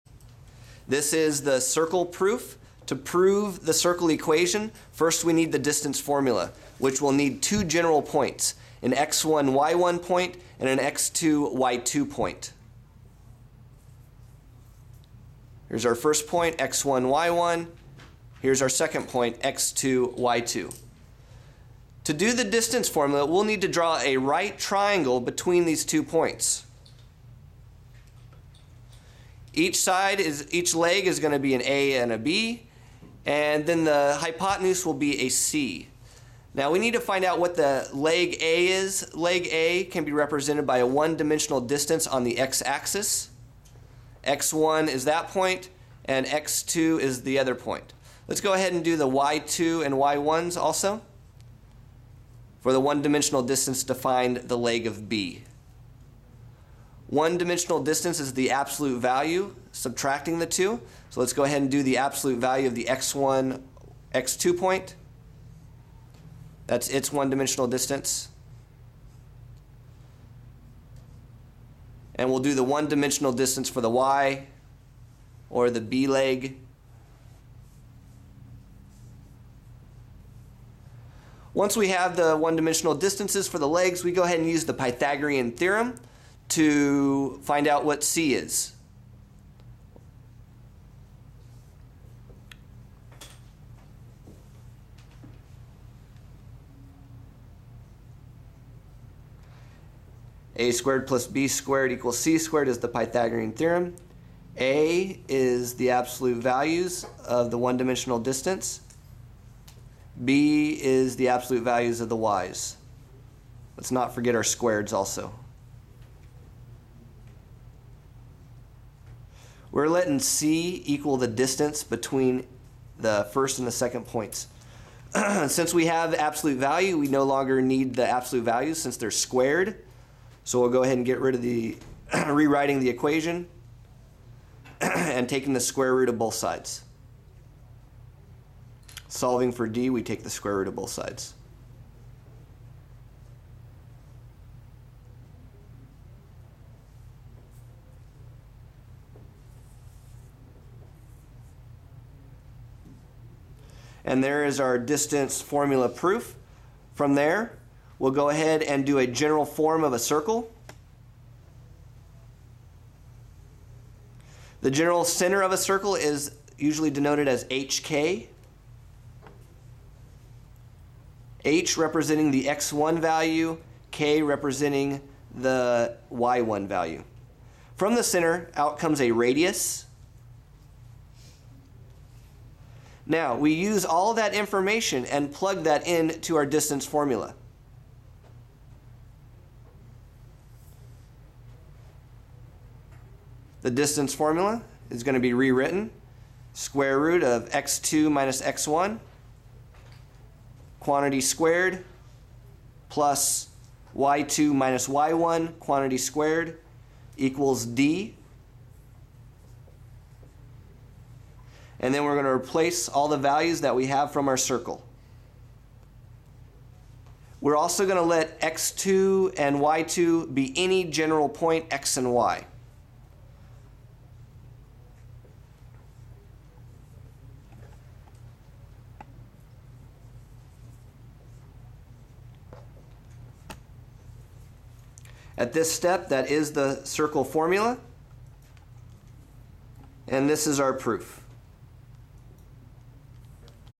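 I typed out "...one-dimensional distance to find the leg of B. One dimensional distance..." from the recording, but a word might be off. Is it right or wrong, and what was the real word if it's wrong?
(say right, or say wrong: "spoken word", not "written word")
right.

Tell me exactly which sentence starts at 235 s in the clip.
At this step, that is the circle formula.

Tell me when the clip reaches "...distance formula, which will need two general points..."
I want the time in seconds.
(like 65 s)
5 s.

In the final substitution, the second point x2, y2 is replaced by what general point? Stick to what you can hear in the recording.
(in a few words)
x and y.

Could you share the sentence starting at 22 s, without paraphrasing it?
To do the distance formula, we'll need to draw a right triangle between these two points.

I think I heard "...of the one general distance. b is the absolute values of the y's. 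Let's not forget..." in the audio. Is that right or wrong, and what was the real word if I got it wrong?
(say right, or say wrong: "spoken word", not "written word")
wrong: "dimensional", not "general".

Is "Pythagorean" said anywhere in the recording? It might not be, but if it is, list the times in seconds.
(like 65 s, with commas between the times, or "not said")
84 s, 102 s.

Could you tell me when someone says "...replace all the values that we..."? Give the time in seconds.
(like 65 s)
212 s.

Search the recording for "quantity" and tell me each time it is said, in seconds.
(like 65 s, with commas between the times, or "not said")
200 s, 205 s.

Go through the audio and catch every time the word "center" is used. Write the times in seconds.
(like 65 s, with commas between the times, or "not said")
165 s, 178 s.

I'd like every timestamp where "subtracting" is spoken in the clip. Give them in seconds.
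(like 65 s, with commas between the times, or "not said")
59 s.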